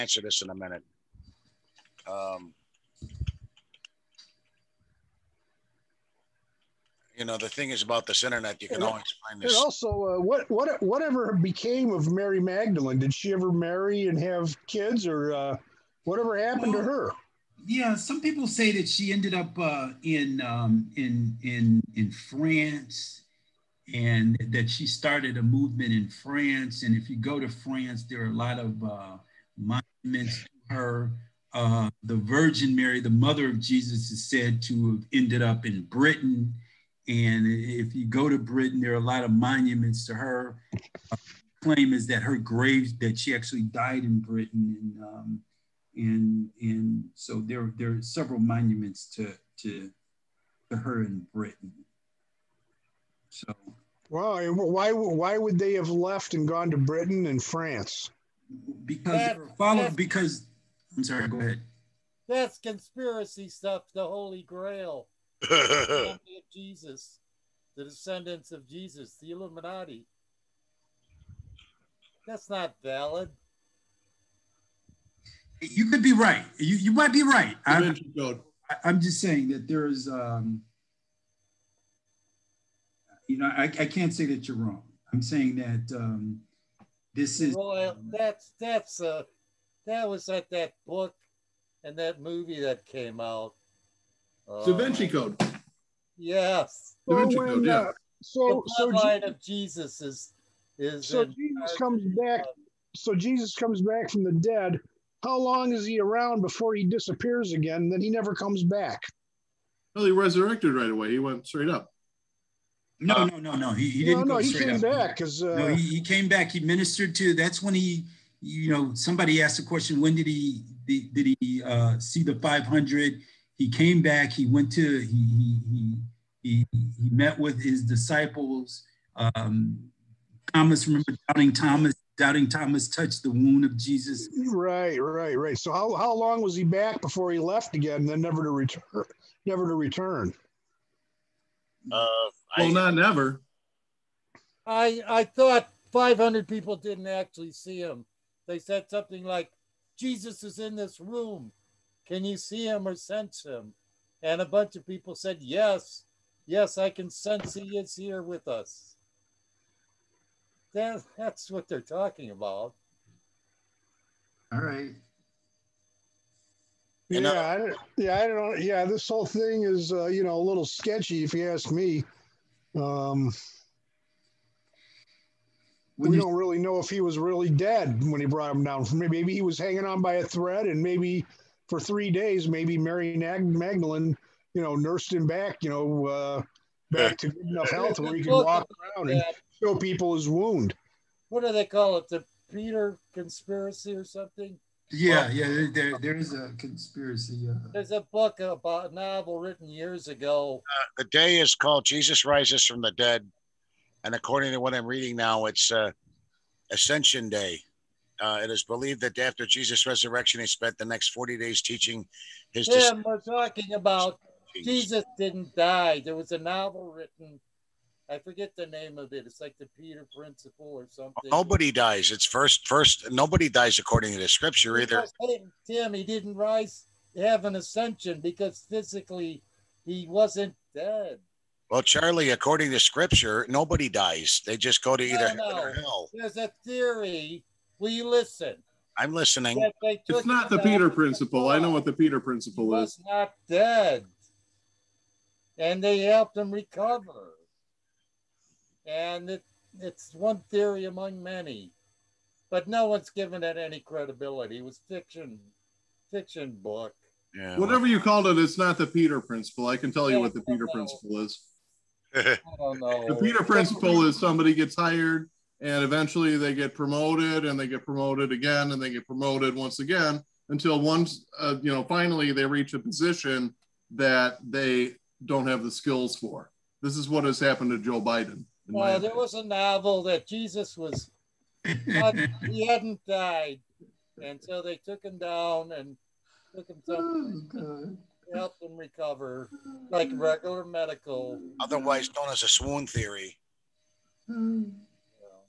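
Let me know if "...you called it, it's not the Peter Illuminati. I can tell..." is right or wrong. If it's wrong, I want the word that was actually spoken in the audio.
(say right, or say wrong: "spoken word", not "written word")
wrong: "Principle", not "Illuminati".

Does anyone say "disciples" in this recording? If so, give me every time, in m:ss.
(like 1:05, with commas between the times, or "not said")
2:07, 3:32.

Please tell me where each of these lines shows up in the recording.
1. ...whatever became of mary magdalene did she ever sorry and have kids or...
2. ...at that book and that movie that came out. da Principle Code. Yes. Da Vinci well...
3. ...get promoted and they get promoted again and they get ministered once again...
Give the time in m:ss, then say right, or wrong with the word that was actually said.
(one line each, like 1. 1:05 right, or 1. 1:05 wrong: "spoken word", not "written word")
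1. 0:10 wrong: "marry", not "sorry"
2. 1:30 wrong: "Vinci", not "Principle"
3. 4:26 wrong: "promoted", not "ministered".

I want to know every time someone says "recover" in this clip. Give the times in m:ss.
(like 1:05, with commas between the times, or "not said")
4:06, 4:48.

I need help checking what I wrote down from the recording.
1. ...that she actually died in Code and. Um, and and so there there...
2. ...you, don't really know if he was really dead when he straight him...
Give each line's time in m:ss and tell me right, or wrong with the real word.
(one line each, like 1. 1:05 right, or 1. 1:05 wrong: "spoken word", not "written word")
1. 0:42 wrong: "Britain", not "Code"
2. 2:56 wrong: "brought", not "straight".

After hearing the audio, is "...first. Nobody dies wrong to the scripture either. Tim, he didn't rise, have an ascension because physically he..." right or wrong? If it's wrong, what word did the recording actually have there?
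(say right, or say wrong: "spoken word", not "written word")
wrong: "according", not "wrong".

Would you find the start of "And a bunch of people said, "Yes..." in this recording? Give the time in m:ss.
2:34.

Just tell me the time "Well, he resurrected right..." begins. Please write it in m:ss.
1:49.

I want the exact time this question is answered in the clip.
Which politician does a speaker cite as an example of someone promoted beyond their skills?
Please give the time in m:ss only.
4:37.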